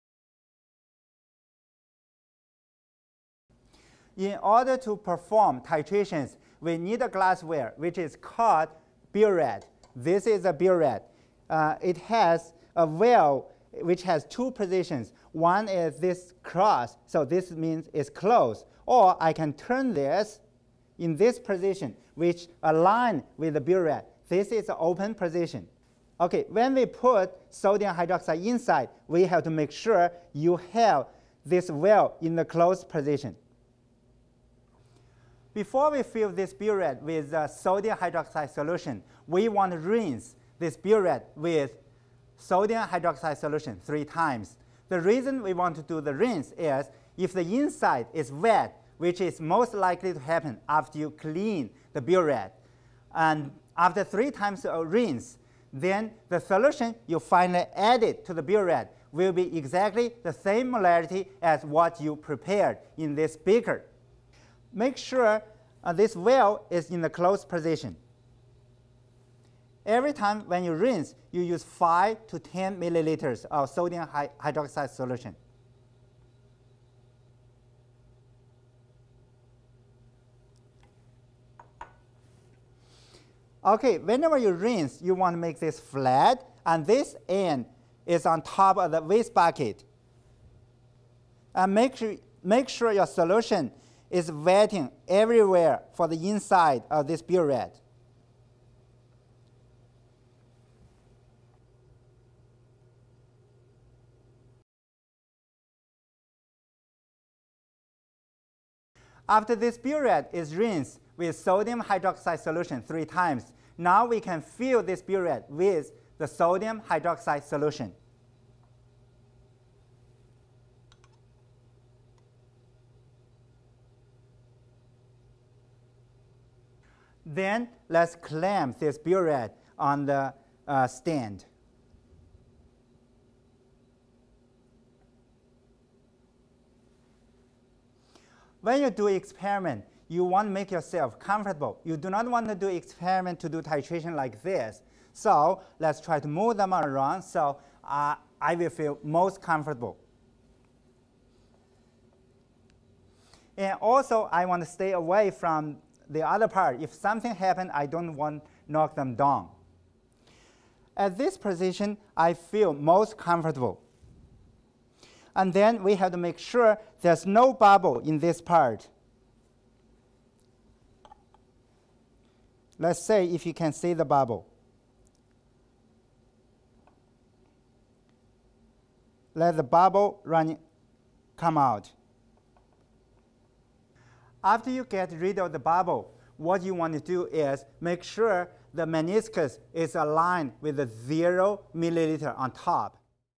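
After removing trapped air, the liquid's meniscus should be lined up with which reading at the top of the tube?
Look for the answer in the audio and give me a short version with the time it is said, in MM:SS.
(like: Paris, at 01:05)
0 milliliters, at 03:10.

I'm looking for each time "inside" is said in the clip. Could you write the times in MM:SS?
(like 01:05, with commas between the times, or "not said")
00:28, 00:47, 01:36.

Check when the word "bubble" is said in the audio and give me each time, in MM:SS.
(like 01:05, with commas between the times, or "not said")
02:47, 02:54, 02:59, 03:05.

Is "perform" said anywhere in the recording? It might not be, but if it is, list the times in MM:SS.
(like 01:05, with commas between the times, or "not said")
00:04.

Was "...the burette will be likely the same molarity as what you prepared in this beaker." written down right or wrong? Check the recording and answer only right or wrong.
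wrong.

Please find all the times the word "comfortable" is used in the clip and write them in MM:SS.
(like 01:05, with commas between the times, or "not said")
02:21, 02:29, 02:43.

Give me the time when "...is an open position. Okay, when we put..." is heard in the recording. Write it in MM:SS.
00:24.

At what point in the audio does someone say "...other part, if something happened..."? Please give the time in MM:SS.
02:36.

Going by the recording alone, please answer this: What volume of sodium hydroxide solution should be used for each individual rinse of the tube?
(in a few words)
5 to 10 milliliters.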